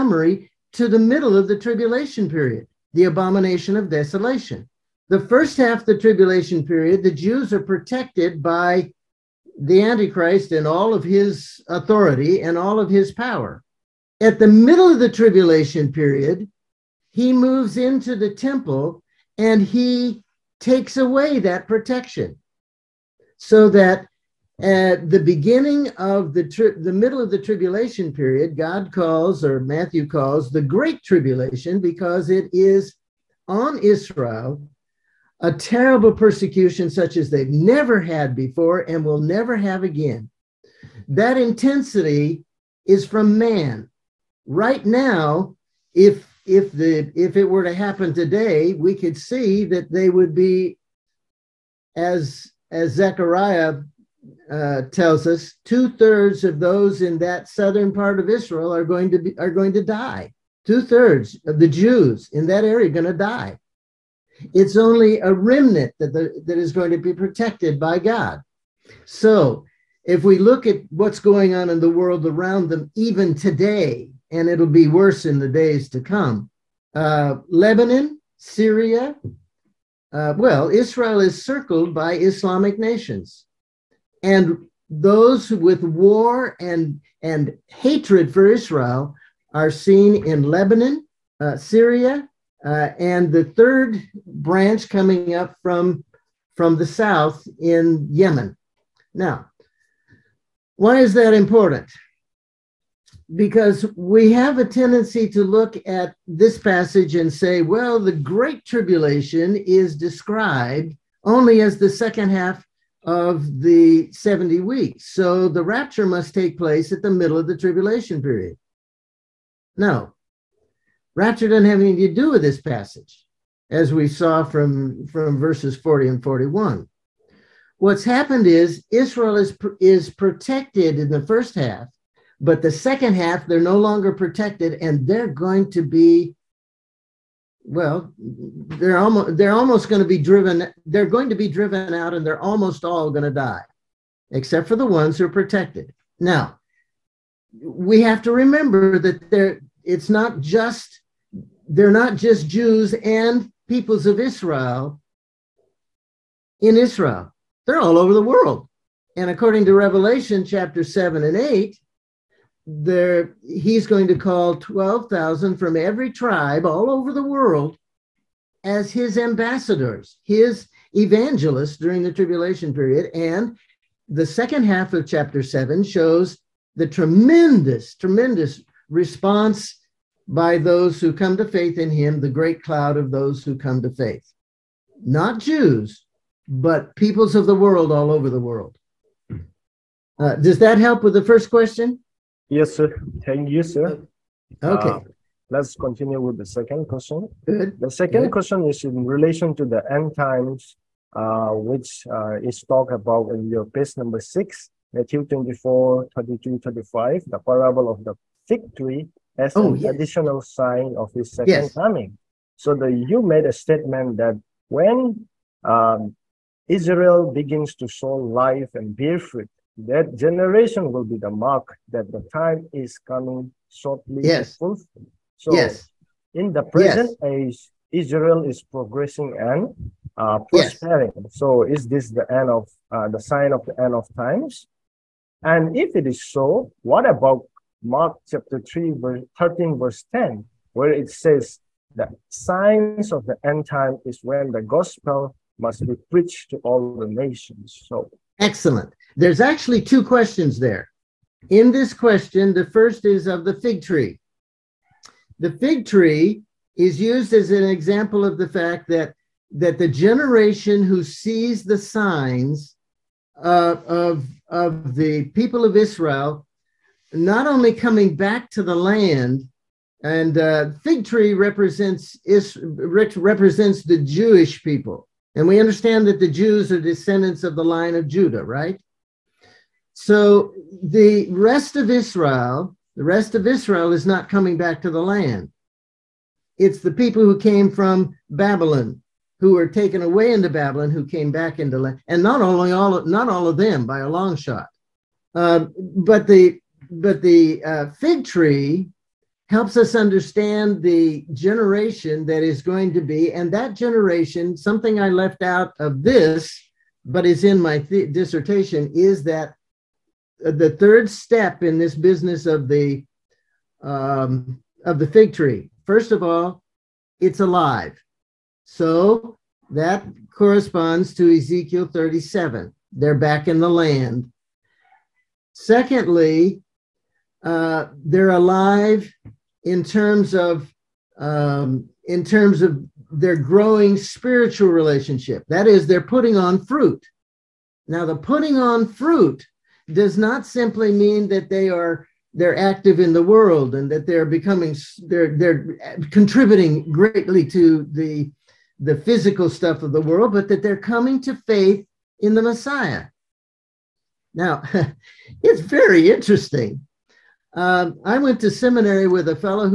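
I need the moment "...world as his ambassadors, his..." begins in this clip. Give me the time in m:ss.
2:47.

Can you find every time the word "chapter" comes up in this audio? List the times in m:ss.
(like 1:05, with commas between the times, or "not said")
2:40, 2:55, 3:58.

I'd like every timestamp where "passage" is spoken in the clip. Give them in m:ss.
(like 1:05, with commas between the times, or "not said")
1:46, 2:02.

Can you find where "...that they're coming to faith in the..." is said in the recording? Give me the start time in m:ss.
5:50.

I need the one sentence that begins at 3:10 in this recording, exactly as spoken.
Uh, does that help with the first question?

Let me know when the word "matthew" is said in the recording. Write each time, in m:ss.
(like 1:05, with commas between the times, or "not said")
0:29, 3:24.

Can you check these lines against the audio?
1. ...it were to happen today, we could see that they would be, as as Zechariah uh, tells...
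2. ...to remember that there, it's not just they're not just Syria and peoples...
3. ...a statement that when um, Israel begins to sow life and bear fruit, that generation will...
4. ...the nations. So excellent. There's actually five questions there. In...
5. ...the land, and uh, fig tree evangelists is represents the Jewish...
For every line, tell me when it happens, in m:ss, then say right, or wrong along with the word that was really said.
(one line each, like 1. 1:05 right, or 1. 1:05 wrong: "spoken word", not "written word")
1. 0:47 right
2. 2:28 wrong: "Jews", not "Syria"
3. 3:33 right
4. 4:06 wrong: "two", not "five"
5. 4:28 wrong: "represents", not "evangelists".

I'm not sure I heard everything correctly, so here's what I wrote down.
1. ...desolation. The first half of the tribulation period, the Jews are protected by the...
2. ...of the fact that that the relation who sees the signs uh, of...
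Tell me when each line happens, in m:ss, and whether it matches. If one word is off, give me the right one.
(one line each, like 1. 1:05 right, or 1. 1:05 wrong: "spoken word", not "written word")
1. 0:03 right
2. 4:18 wrong: "generation", not "relation".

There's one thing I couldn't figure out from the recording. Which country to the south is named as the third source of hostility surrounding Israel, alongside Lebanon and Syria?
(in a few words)
Yemen.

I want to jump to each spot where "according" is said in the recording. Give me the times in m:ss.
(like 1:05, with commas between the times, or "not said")
2:39.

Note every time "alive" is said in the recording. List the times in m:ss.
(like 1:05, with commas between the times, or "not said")
5:17, 5:28.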